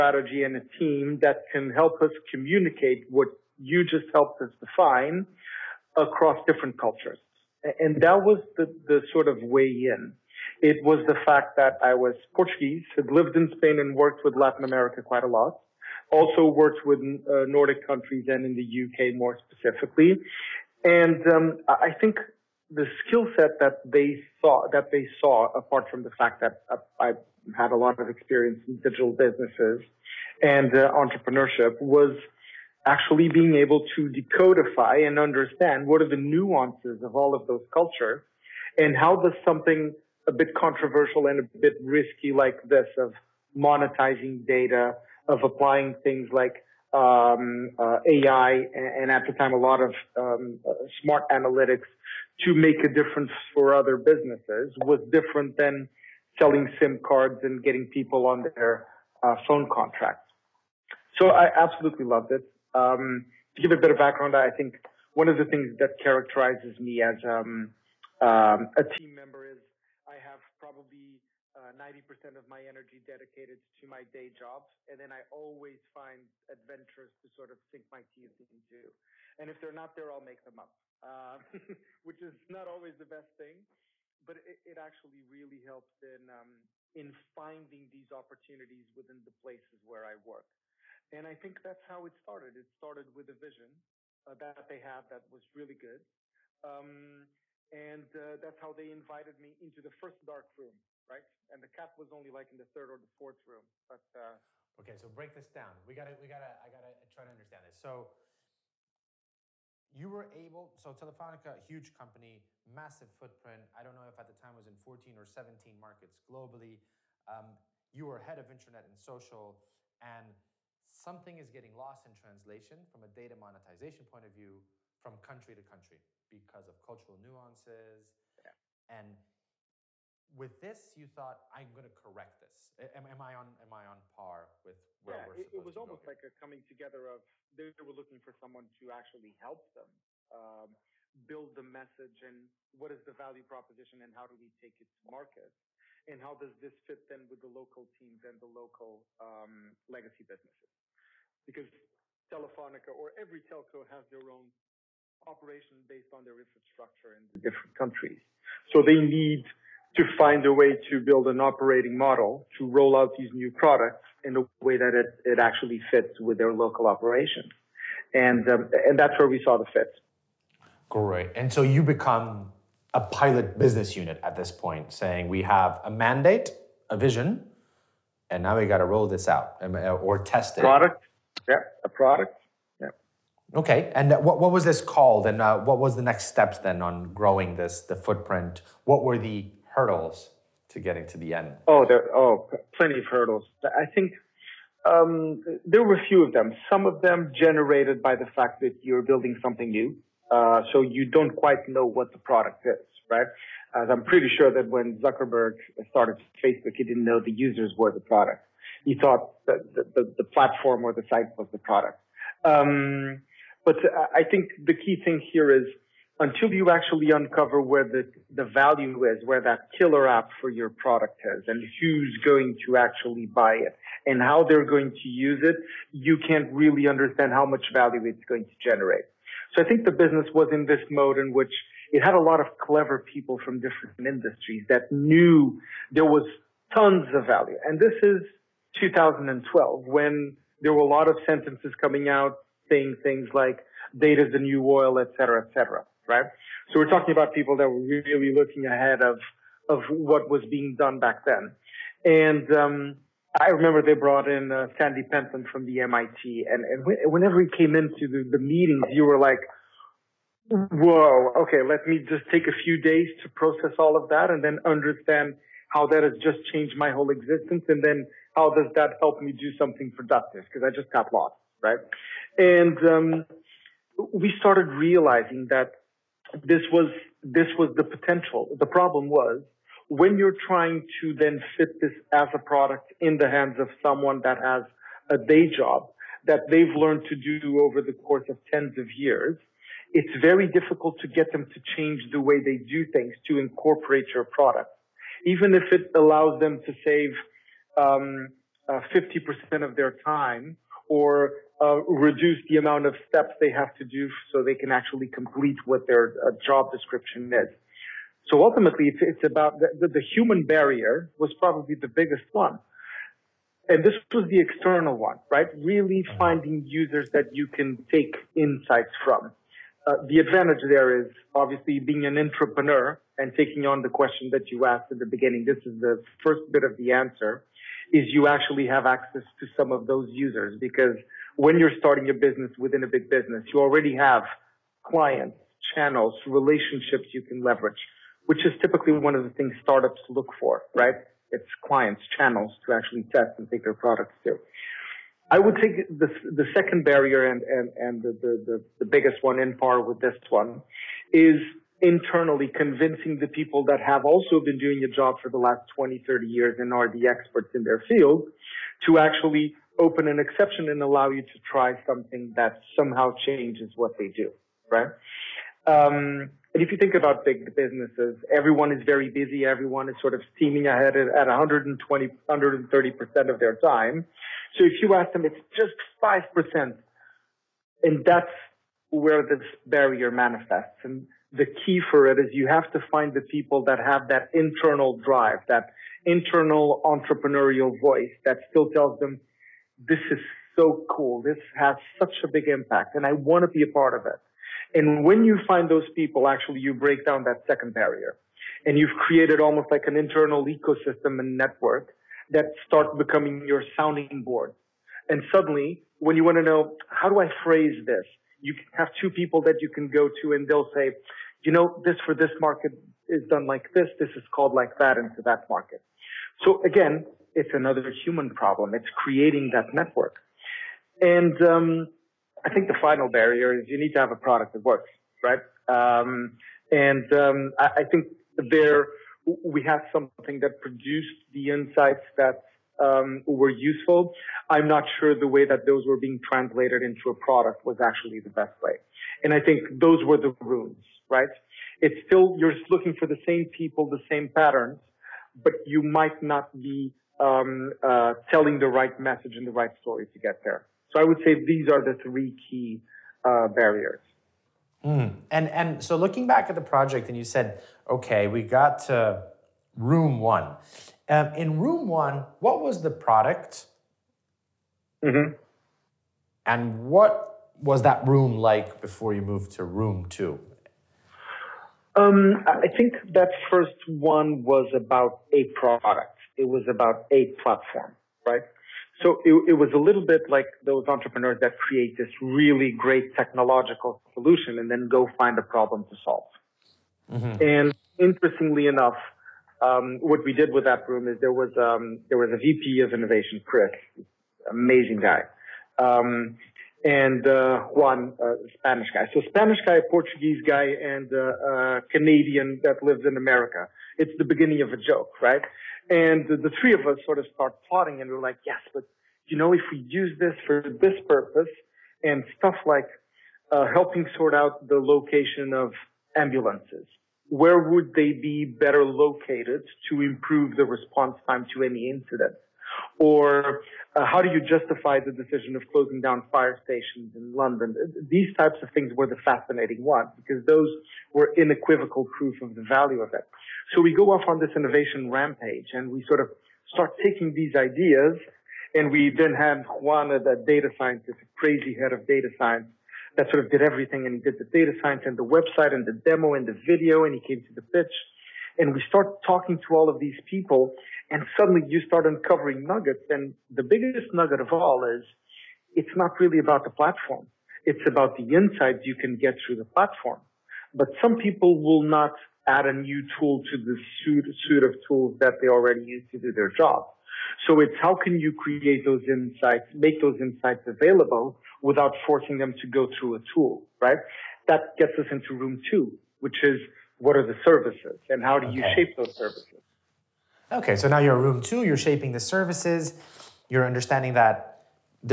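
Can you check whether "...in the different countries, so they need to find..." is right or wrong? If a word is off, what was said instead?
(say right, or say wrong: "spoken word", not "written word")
right.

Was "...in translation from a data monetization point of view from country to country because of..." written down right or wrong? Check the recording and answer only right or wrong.
right.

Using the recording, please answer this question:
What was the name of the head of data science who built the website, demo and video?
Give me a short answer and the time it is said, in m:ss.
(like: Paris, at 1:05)
Juana, at 8:59.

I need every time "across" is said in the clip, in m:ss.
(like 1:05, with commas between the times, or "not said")
0:05.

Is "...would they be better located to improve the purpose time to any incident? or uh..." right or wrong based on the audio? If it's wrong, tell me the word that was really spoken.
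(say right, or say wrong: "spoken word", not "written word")
wrong: "response", not "purpose".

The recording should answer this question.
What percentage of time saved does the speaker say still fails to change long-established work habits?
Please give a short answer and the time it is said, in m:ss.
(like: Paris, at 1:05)
50%, at 4:58.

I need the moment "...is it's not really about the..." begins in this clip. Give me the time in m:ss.
9:14.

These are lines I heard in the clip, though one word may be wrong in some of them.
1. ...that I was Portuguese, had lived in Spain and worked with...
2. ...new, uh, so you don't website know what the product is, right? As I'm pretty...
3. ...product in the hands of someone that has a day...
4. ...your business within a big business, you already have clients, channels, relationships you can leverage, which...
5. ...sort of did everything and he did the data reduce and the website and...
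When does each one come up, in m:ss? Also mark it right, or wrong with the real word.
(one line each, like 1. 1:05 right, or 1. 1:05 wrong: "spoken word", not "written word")
1. 0:11 right
2. 3:19 wrong: "quite", not "website"
3. 4:42 right
4. 5:32 right
5. 9:03 wrong: "science", not "reduce".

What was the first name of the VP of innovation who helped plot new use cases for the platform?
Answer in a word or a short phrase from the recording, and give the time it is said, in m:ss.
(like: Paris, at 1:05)
Chris, at 8:13.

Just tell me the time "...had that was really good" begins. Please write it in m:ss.
1:34.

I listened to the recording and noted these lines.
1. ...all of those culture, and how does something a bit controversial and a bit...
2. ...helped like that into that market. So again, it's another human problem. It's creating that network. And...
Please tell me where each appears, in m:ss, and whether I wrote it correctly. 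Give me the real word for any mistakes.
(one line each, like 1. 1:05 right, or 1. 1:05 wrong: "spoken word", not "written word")
1. 0:37 right
2. 6:54 wrong: "called", not "helped".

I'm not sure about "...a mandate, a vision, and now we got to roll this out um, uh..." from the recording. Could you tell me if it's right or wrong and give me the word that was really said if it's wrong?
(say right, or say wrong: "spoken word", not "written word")
right.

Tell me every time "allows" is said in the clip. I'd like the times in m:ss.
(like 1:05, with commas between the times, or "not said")
4:55, 6:00.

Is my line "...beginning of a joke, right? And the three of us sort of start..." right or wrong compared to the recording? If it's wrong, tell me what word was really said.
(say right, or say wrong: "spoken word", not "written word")
right.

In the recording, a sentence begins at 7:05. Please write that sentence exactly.
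Um, and um, I, I, think there we have something that produced the insights that um, were useful.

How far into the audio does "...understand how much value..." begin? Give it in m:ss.
3:46.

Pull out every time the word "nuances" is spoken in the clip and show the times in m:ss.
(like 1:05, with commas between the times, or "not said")
0:36, 2:07.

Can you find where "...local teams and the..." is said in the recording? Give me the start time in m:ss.
2:27.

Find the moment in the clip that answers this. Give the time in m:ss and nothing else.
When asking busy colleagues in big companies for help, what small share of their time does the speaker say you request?
6:16.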